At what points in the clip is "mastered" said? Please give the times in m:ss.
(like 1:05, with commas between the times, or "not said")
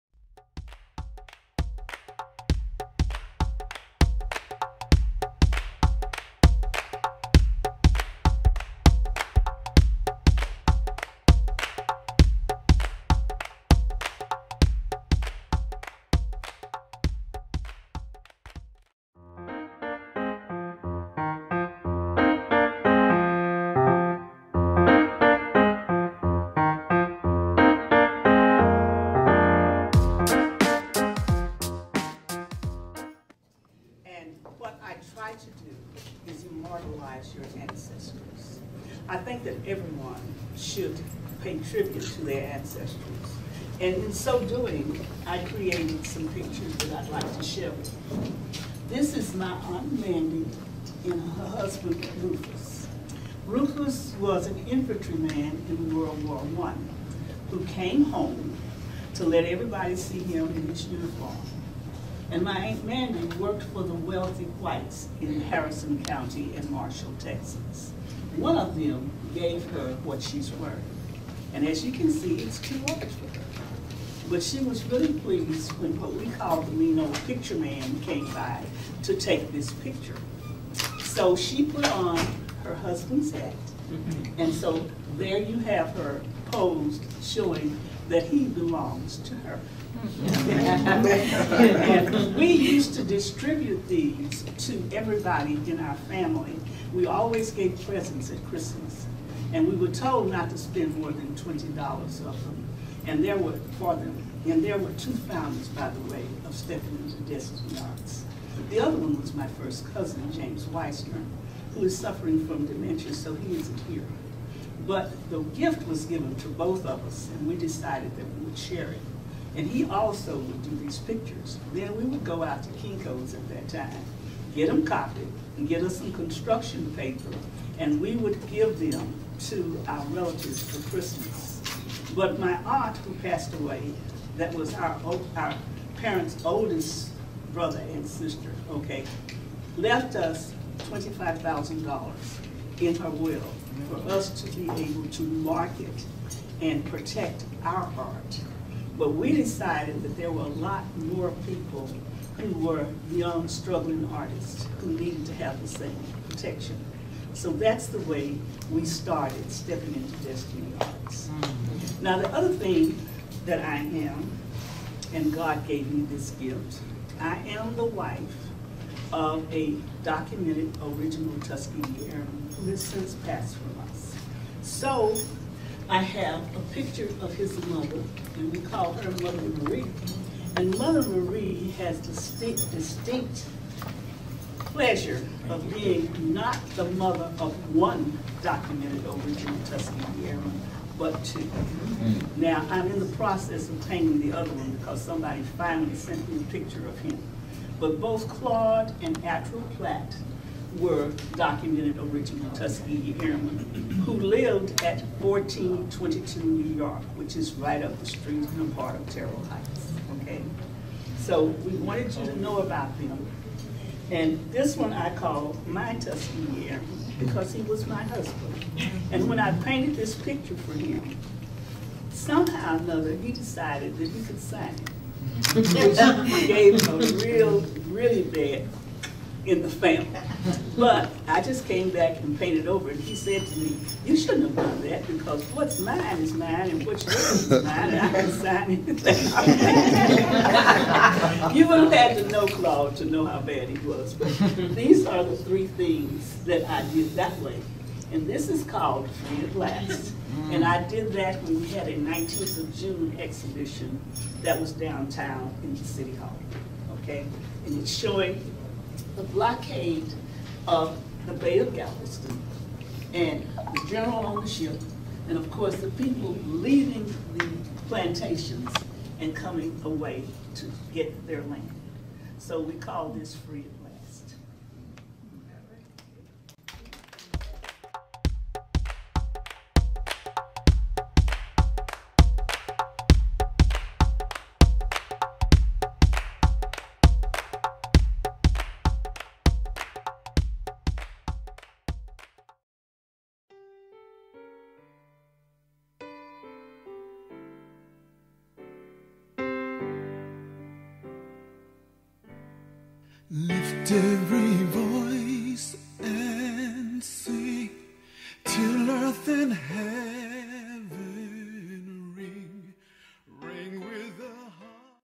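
not said.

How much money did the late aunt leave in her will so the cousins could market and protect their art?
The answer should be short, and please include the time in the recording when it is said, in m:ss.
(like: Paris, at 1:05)
$25,000, at 2:20.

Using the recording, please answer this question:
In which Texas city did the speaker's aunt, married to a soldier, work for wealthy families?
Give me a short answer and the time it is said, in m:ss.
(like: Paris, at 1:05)
Marshall, at 1:06.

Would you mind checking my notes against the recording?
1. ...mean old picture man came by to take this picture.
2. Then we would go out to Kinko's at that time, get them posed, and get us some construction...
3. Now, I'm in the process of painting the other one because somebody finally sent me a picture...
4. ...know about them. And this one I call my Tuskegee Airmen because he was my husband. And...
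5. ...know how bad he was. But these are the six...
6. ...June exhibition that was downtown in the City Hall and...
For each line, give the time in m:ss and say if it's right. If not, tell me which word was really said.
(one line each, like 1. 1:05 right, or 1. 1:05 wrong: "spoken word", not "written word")
1. 1:16 right
2. 2:01 wrong: "copied", not "posed"
3. 3:12 right
4. 3:32 right
5. 4:03 wrong: "three", not "six"
6. 4:12 right.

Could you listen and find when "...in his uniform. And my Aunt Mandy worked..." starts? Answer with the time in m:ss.
1:00.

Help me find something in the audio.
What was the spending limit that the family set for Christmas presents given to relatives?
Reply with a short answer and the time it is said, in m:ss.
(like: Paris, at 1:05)
$20, at 1:41.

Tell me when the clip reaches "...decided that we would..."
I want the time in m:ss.
1:57.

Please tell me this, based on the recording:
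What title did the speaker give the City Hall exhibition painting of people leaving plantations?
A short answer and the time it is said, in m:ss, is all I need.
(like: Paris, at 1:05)
Free at Last, at 4:09.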